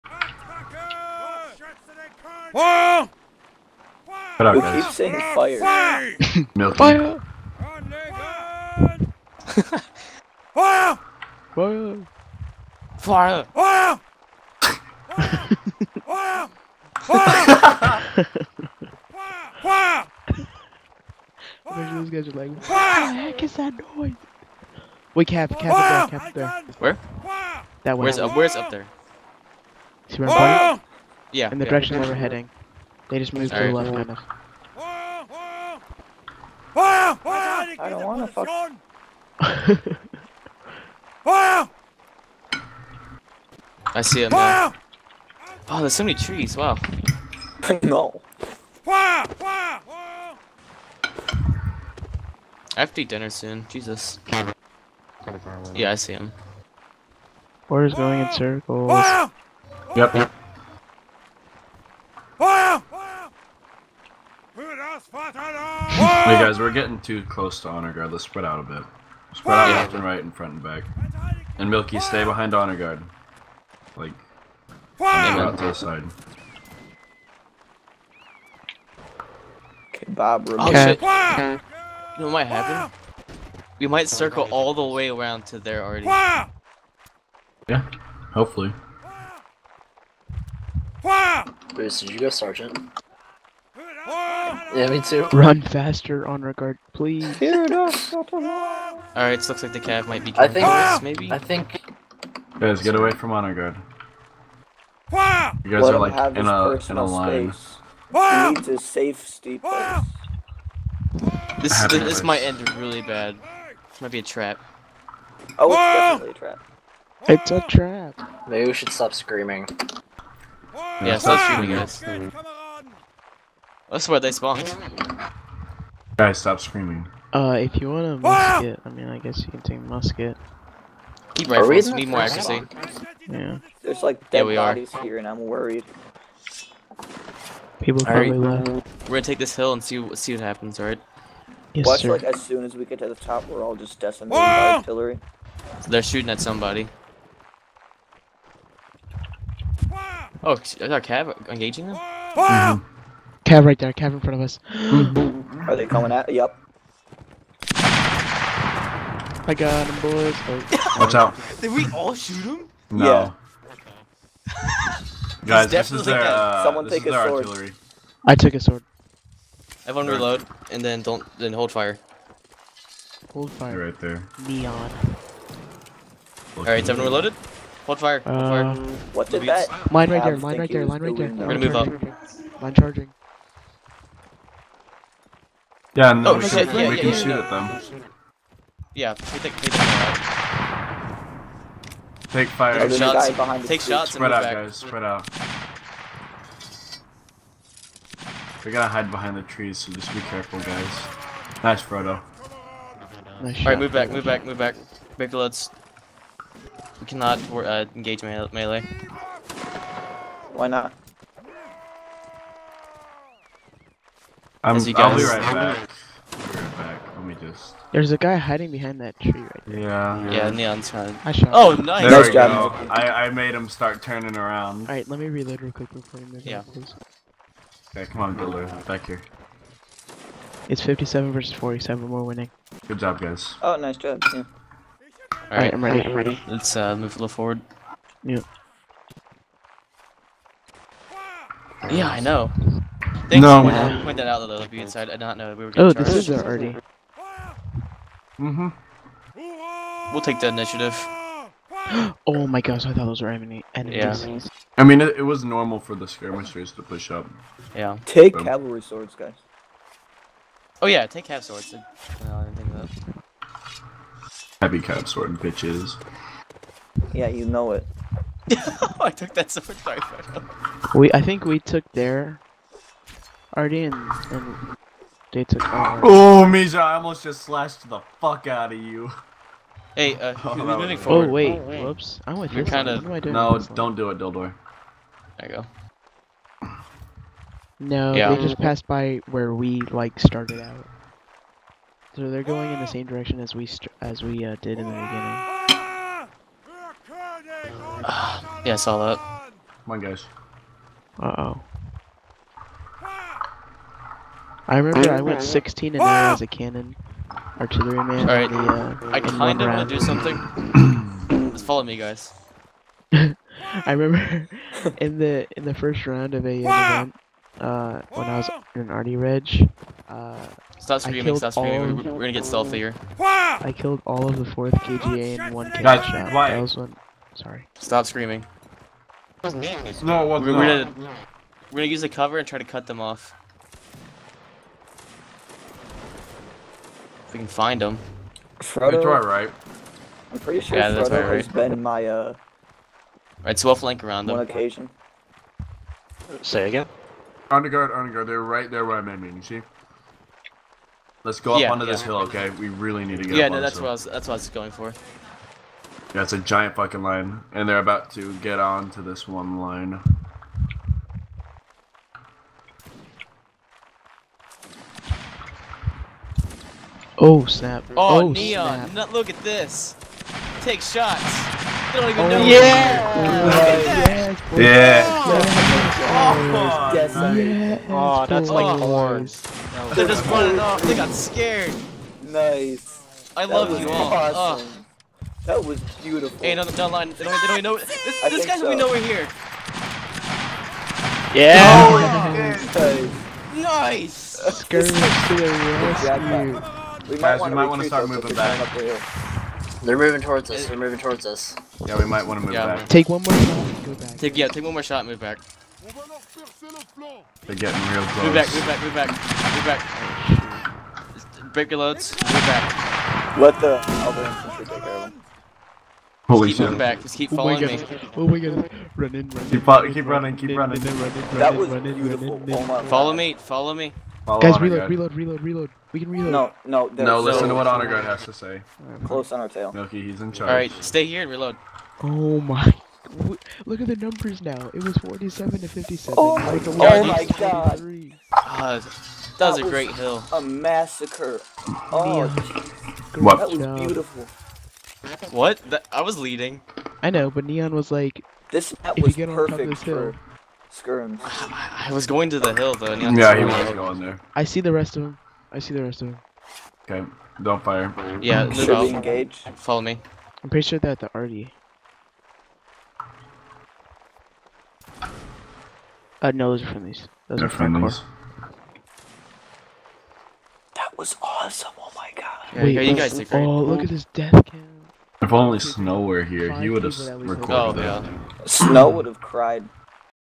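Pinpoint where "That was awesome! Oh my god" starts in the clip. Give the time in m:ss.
7:50.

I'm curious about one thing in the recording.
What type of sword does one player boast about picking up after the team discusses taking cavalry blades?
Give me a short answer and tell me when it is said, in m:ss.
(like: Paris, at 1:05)
Heavy code sword, at 4:24.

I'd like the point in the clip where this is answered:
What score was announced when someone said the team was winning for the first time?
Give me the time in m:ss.
3:50.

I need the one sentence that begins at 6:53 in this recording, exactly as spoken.
Let the other infantry take care of them.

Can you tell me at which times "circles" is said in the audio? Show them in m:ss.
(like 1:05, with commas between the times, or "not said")
0:58, 1:24.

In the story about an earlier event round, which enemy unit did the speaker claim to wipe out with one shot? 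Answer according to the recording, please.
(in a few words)
4th KGA.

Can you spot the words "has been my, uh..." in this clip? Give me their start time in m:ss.
5:41.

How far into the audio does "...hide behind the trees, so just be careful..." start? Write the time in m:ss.
3:18.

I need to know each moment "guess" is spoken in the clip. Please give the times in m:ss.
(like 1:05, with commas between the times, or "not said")
2:09.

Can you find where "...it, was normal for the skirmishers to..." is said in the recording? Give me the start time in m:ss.
4:15.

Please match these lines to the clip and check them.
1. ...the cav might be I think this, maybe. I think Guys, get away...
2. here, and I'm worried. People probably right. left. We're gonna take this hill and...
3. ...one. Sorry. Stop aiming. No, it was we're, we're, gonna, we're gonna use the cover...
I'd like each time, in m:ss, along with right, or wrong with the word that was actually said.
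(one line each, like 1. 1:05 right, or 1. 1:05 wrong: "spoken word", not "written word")
1. 1:39 right
2. 2:15 right
3. 5:26 wrong: "screaming", not "aiming".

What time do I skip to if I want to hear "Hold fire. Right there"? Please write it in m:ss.
2:53.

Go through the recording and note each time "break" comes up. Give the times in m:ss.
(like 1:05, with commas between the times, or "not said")
6:51.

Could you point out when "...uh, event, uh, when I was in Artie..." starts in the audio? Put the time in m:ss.
5:16.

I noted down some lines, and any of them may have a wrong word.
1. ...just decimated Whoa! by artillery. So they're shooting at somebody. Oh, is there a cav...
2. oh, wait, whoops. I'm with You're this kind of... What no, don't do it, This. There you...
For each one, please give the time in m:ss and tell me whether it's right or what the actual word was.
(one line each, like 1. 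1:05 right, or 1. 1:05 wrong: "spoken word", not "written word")
1. 2:23 right
2. 4:41 wrong: "Dildor", not "This".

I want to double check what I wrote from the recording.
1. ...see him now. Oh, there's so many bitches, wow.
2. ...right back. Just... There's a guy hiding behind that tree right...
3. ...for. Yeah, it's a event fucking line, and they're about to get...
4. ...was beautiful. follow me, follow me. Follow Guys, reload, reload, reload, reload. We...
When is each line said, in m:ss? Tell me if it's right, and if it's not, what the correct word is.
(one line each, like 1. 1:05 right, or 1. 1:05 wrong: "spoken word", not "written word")
1. 0:44 wrong: "trees", not "bitches"
2. 3:35 right
3. 5:54 wrong: "giant", not "event"
4. 7:01 right.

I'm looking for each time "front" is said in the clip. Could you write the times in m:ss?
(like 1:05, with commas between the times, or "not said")
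1:10, 2:34.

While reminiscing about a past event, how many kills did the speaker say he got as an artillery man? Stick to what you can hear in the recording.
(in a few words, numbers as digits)
16.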